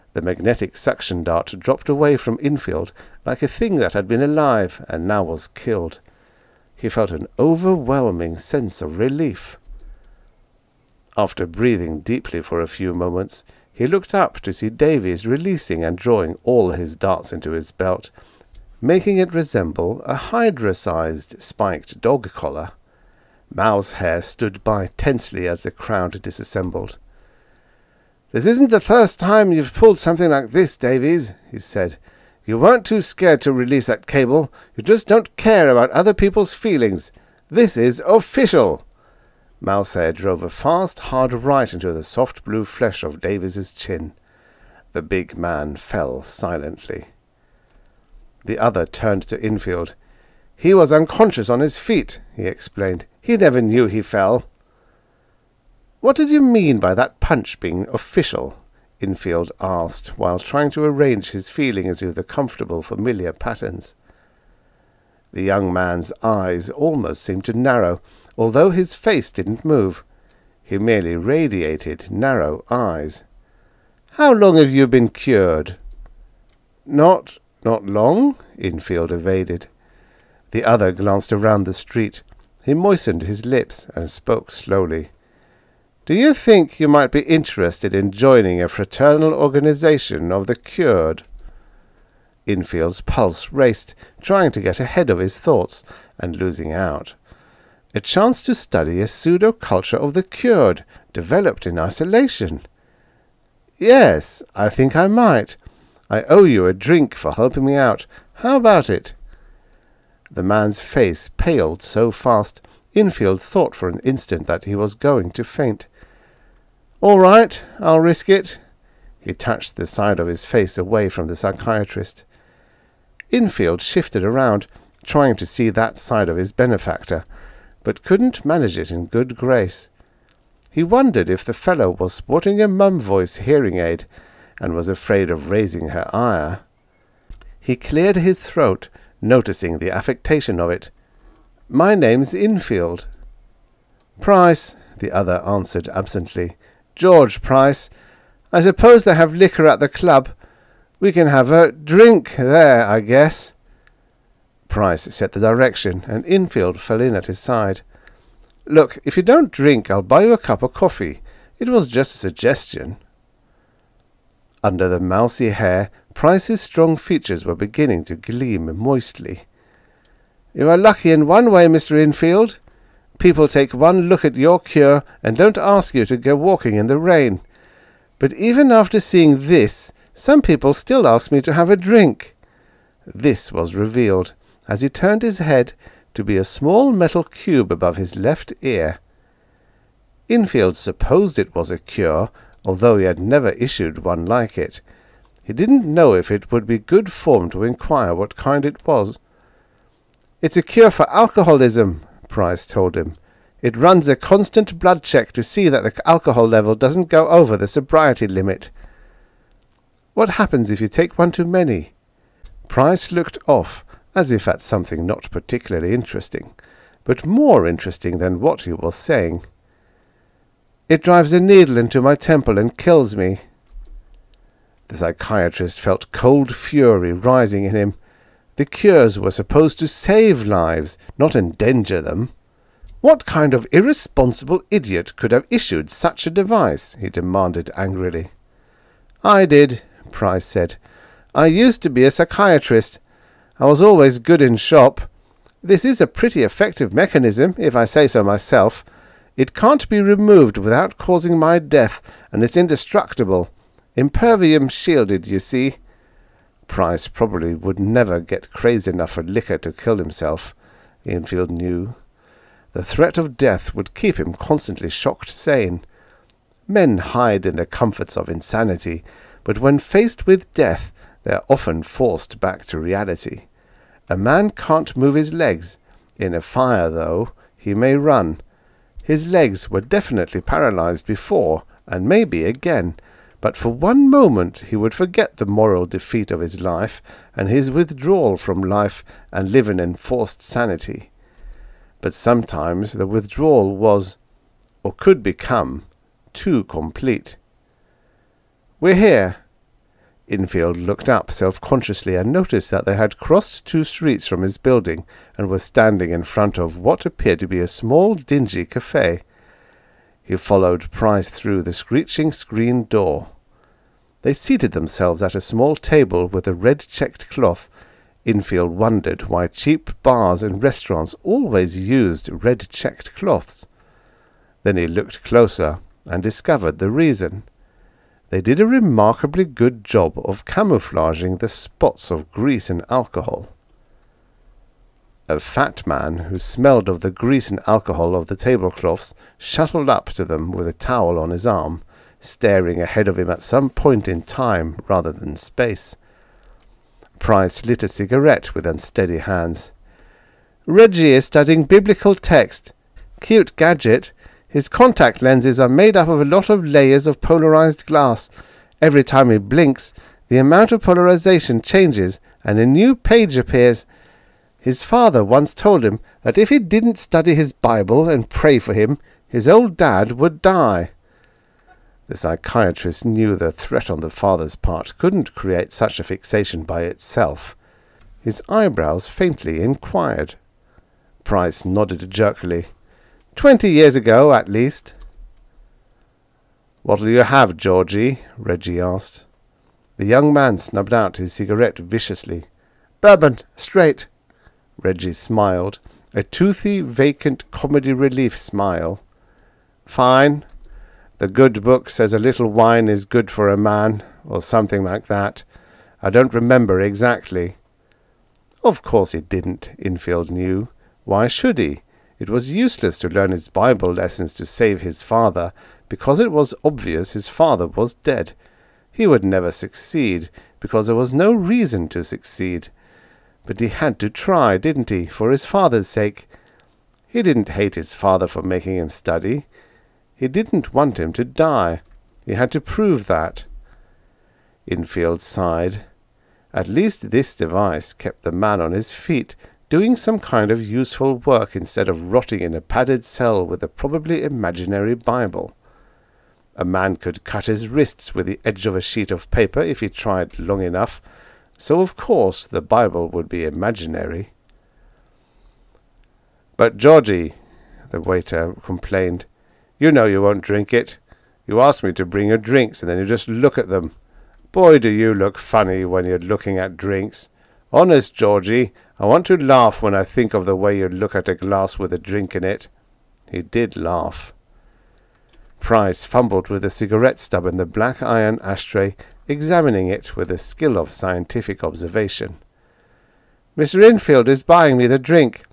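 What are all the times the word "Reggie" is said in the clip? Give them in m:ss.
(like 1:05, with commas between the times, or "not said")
5:50, 6:28, 6:34.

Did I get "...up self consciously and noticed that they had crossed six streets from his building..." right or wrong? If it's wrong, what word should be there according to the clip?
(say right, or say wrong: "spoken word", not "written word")
wrong: "two", not "six".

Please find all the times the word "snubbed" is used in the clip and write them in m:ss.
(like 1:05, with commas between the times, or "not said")
6:30.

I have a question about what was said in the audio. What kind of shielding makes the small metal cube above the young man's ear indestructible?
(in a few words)
Impervium.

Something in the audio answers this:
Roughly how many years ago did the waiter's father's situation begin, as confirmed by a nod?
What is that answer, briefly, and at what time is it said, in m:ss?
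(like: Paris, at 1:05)
20, at 6:23.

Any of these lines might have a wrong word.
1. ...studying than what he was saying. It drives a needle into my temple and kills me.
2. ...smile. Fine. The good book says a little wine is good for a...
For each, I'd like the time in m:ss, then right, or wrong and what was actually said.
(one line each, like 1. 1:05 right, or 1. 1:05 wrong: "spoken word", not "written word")
1. 3:37 wrong: "interesting", not "studying"
2. 6:38 right.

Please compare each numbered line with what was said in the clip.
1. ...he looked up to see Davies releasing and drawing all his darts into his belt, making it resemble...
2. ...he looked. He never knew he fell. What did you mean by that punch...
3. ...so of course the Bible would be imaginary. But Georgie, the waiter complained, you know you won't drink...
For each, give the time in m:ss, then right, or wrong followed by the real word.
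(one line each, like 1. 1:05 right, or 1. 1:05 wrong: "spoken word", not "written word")
1. 0:13 right
2. 0:52 wrong: "explained", not "looked"
3. 7:31 right.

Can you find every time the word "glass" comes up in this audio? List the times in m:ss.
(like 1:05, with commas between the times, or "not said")
5:57, 7:51.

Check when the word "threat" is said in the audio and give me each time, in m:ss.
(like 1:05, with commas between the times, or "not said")
4:22, 6:13.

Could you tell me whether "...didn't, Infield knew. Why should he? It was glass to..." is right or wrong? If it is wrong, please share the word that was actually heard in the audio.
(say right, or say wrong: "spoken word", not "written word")
wrong: "useless", not "glass".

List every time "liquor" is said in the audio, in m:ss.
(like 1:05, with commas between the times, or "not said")
2:29, 4:19.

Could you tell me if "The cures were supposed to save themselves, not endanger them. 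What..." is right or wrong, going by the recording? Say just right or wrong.
wrong.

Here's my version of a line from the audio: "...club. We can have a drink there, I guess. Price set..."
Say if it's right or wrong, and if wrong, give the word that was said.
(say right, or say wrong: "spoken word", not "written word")
right.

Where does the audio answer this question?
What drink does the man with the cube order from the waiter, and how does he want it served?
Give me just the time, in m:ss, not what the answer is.
6:33.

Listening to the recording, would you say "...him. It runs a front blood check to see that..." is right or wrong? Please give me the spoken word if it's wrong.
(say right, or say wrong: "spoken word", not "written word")
wrong: "constant", not "front".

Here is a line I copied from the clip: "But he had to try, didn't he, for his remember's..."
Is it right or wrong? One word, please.
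wrong.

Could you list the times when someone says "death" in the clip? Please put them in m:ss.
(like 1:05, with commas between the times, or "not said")
4:11, 4:23, 4:30.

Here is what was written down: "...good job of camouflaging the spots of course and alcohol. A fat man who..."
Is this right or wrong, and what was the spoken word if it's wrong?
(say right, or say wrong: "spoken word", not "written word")
wrong: "grease", not "course".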